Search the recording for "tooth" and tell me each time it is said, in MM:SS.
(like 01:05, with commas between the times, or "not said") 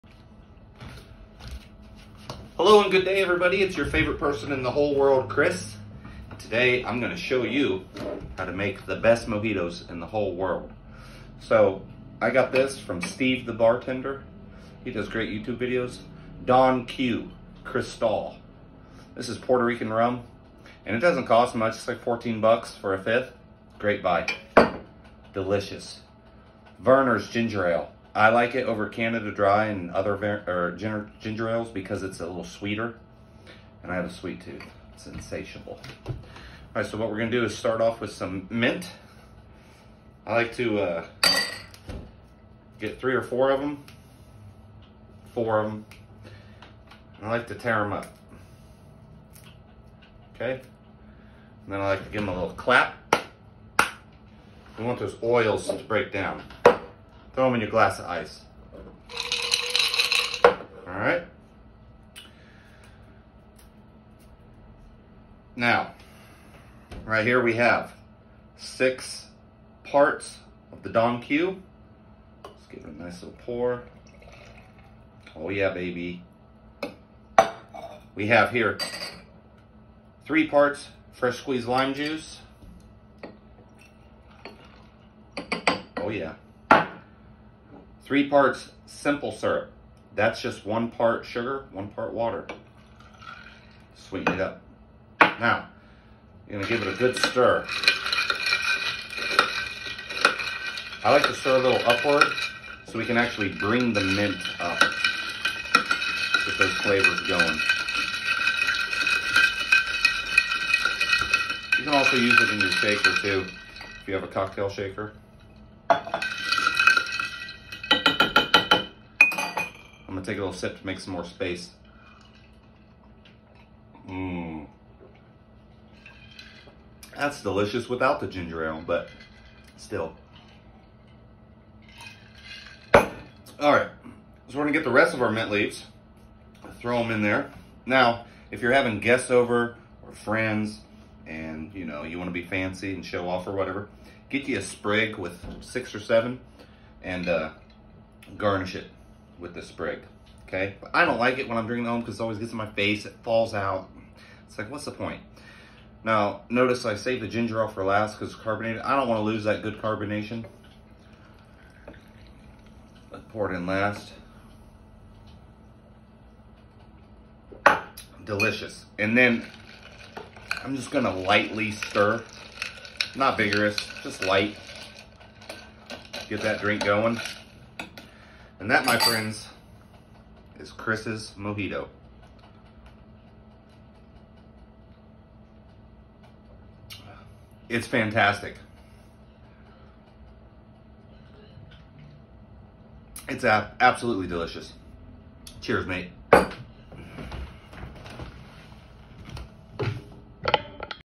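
00:34.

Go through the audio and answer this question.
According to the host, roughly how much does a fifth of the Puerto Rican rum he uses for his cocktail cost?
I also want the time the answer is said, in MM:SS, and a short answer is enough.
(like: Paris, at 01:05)
14 bucks, at 00:22.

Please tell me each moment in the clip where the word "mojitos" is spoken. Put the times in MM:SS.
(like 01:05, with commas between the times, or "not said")
00:09, 03:01.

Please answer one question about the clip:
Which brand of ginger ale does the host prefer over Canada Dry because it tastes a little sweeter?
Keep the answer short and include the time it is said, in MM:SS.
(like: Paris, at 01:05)
Vernors, at 00:26.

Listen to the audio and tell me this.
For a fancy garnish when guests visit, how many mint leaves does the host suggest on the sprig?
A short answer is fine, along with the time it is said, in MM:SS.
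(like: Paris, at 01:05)
6 or 7, at 02:25.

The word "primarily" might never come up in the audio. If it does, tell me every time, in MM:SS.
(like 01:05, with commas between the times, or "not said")
not said.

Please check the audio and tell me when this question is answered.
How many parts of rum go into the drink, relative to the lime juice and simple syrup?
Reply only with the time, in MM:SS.
01:08.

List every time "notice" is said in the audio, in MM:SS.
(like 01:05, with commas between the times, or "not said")
02:36.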